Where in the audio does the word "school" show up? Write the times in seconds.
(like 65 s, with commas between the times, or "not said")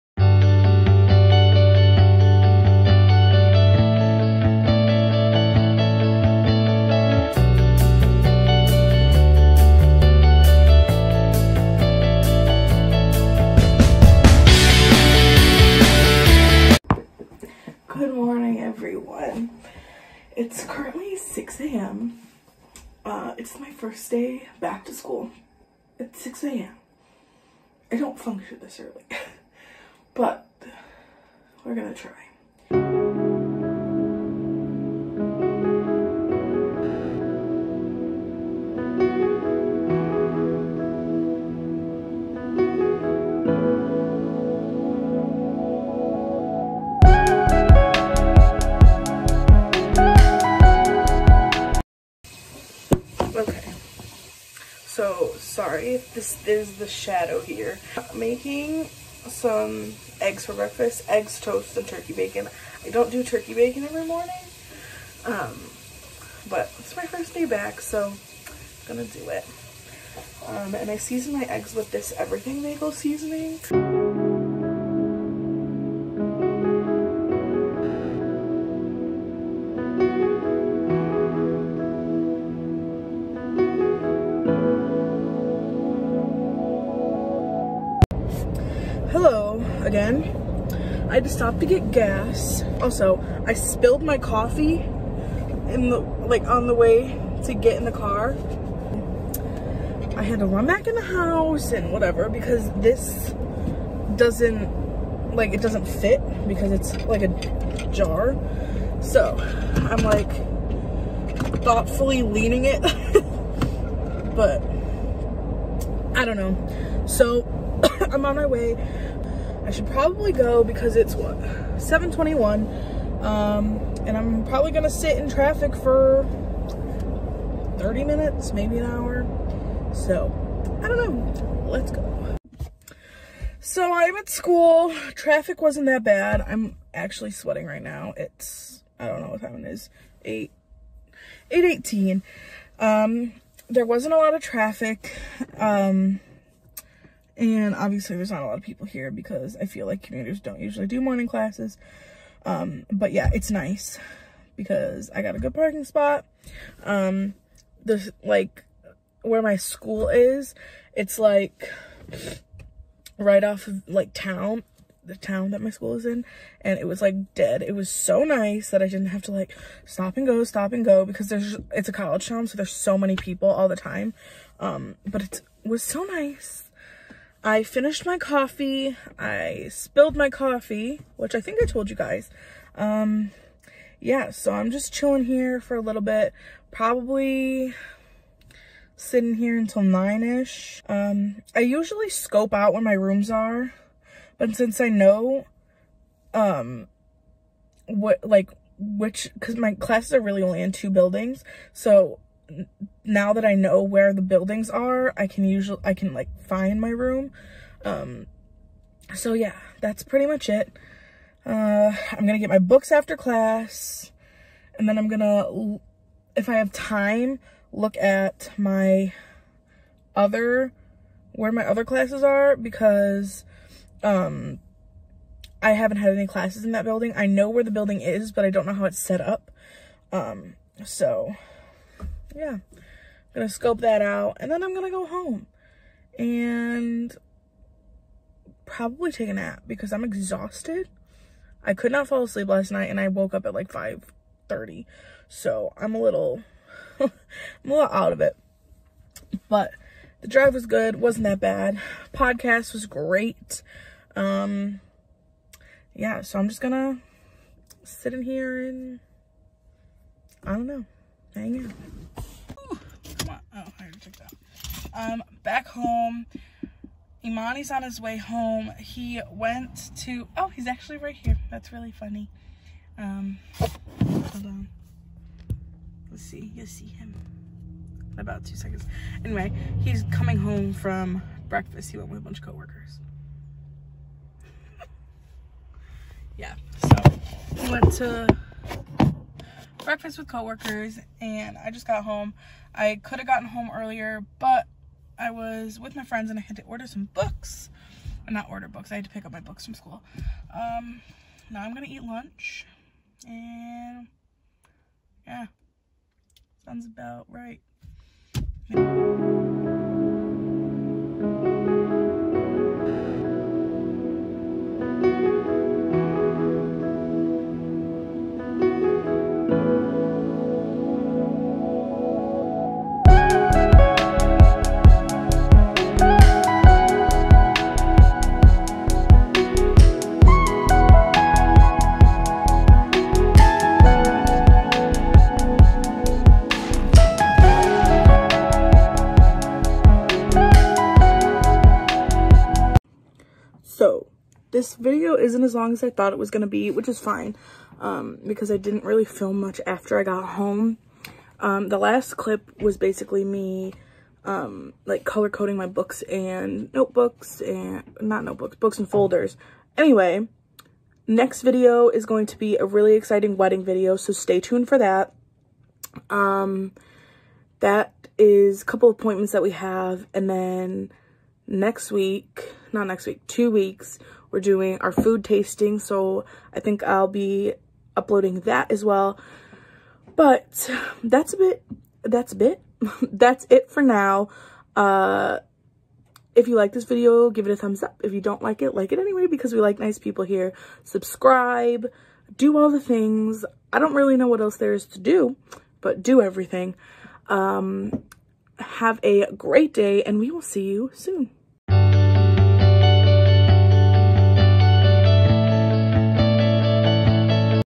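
24 s, 134 s, 159 s, 165 s, 299 s.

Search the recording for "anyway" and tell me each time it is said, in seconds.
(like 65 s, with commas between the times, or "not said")
279 s, 359 s, 388 s.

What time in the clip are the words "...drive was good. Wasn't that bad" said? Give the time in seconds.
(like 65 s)
250 s.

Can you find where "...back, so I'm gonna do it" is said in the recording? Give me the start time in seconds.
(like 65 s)
67 s.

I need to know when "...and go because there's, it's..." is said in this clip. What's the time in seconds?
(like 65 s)
170 s.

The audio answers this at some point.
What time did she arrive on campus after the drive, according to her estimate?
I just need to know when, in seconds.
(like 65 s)
141 s.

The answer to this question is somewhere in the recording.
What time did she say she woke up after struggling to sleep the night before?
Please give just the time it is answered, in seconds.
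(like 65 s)
243 s.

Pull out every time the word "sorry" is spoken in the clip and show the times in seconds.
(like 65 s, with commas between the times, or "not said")
55 s.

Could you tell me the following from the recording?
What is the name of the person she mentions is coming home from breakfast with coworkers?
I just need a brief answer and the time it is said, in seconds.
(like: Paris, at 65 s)
Imani, at 267 s.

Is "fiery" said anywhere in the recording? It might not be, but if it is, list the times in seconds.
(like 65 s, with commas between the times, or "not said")
not said.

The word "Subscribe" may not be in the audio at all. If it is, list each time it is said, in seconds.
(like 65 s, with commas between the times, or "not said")
390 s.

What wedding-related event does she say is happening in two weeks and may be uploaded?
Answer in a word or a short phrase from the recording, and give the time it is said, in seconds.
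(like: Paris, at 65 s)
Food tasting, at 374 s.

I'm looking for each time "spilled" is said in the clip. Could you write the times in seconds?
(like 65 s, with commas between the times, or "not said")
93 s, 179 s.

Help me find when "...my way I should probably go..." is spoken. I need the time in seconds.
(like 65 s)
118 s.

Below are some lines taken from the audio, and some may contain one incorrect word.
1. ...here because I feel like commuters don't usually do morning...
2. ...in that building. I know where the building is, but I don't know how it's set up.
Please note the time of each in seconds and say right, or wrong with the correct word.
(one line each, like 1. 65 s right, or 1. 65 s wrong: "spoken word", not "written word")
1. 148 s right
2. 226 s right.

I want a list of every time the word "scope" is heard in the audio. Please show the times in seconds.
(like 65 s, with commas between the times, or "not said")
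192 s, 233 s.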